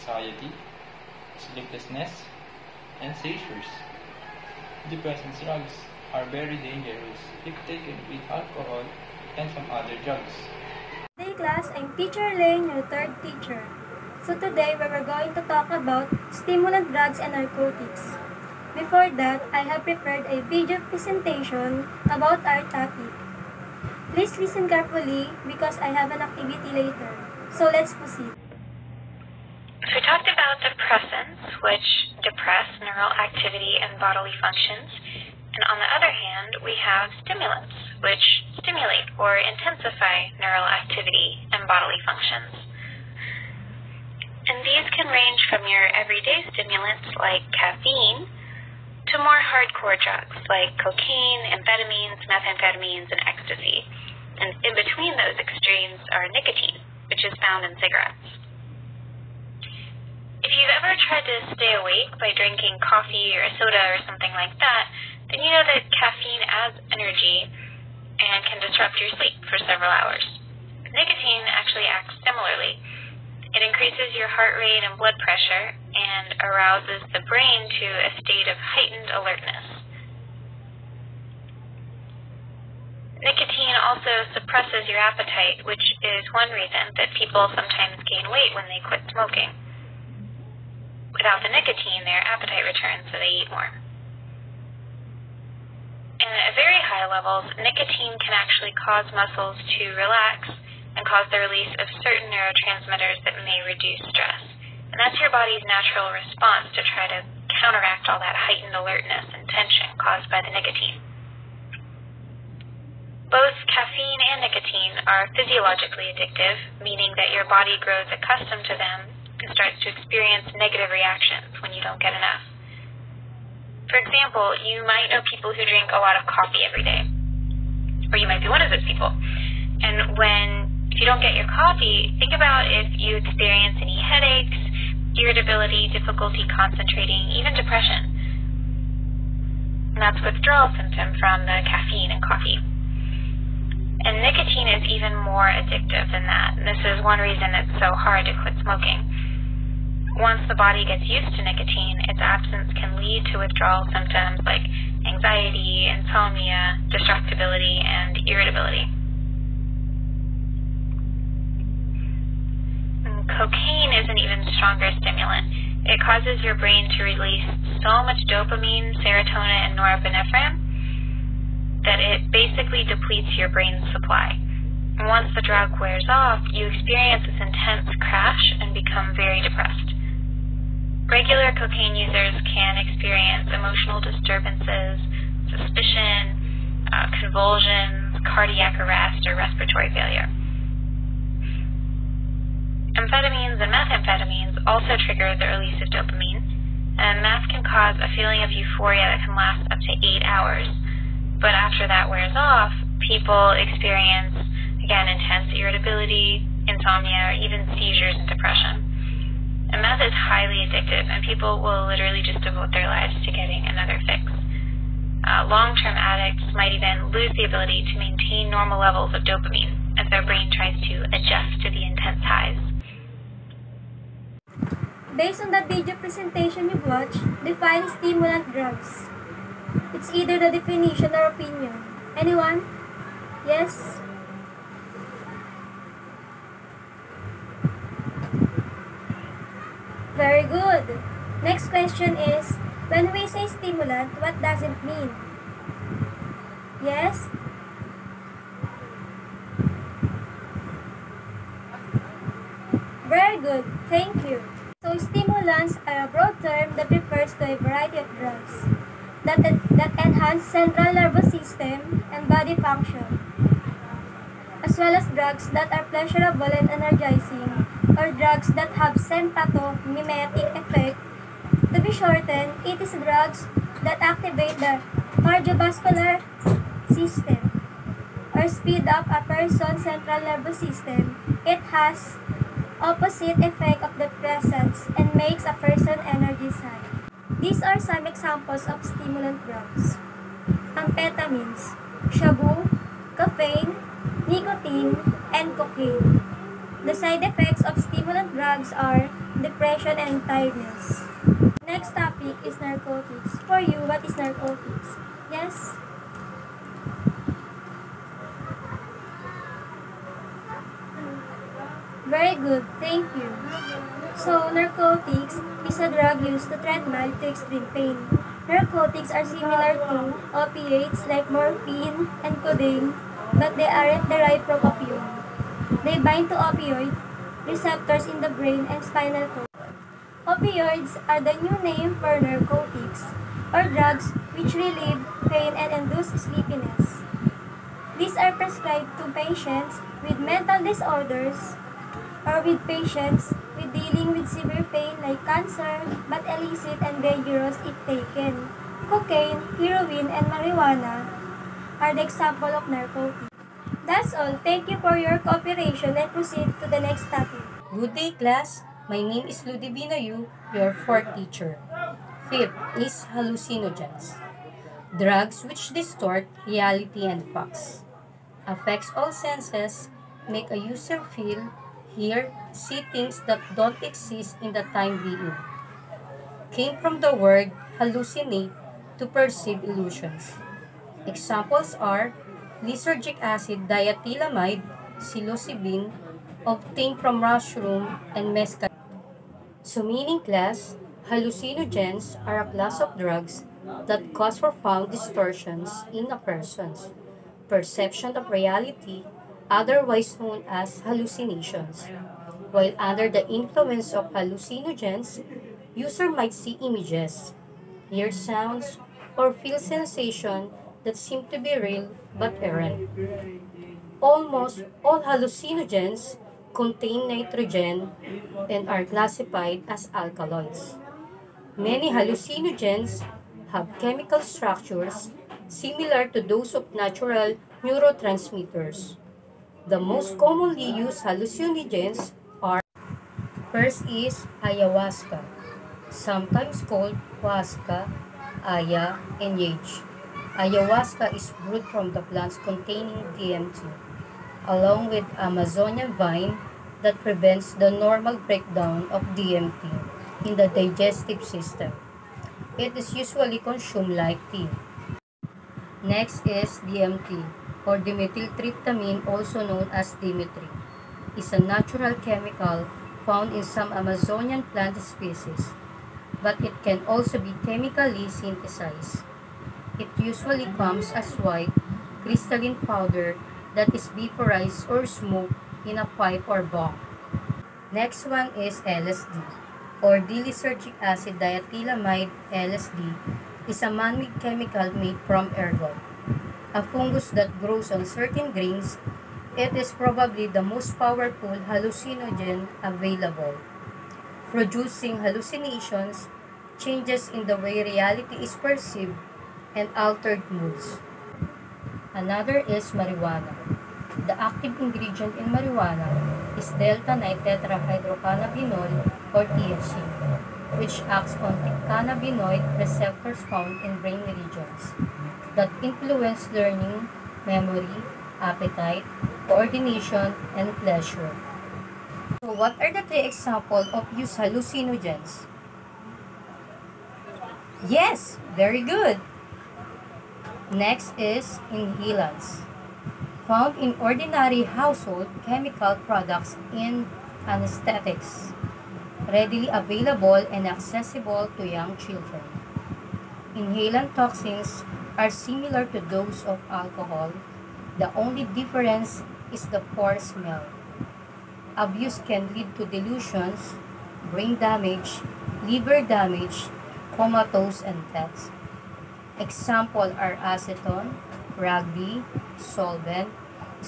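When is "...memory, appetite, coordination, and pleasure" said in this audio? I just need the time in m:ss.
8:37.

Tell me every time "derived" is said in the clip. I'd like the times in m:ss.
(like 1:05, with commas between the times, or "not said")
5:24.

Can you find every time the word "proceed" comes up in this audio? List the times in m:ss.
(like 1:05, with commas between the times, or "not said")
0:27, 5:56.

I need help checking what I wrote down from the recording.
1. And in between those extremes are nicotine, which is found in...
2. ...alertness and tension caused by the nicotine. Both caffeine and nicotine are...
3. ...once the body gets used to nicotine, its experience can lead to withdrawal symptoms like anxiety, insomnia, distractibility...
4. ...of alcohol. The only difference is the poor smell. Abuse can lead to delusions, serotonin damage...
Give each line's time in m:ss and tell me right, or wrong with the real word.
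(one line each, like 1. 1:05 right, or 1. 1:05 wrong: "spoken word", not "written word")
1. 0:54 right
2. 1:48 right
3. 2:30 wrong: "absence", not "experience"
4. 9:06 wrong: "brain", not "serotonin".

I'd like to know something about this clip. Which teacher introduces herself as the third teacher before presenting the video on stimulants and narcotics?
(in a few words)
Teacher Lane.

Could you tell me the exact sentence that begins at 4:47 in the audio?
These are some examples of stimulant drugs.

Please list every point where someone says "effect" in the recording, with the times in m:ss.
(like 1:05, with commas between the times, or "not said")
4:30, 4:43, 4:57.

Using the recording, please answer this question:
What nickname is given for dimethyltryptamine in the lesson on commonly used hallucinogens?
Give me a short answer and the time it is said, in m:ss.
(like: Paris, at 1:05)
Dimitri, at 7:39.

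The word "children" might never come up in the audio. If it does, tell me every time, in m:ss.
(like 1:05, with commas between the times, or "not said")
9:01.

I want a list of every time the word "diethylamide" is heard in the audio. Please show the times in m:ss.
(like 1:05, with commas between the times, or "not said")
6:23, 8:01.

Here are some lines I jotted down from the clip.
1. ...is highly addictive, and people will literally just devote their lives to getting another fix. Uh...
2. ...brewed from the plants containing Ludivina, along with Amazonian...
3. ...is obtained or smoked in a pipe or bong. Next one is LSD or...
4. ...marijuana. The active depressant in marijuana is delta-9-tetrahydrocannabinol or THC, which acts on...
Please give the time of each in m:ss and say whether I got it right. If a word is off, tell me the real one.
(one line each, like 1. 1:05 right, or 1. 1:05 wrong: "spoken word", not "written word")
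1. 3:30 right
2. 7:21 wrong: "DMT", not "Ludivina"
3. 7:53 wrong: "vaporized", not "obtained"
4. 8:22 wrong: "ingredient", not "depressant".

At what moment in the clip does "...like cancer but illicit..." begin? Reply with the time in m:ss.
5:44.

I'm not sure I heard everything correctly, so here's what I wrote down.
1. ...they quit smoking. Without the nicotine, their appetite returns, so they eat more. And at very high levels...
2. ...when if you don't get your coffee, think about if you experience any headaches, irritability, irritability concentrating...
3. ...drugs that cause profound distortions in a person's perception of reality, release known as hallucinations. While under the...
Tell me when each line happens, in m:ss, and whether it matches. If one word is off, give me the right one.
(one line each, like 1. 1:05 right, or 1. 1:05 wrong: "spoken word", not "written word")
1. 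1:28 right
2. 2:10 wrong: "difficulty", not "irritability"
3. 6:32 wrong: "otherwise", not "release".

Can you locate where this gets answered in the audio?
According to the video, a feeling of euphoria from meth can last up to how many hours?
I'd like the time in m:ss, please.
3:20.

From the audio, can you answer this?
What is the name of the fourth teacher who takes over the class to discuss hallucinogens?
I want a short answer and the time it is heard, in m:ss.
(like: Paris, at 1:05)
Ludivina Yu, at 5:59.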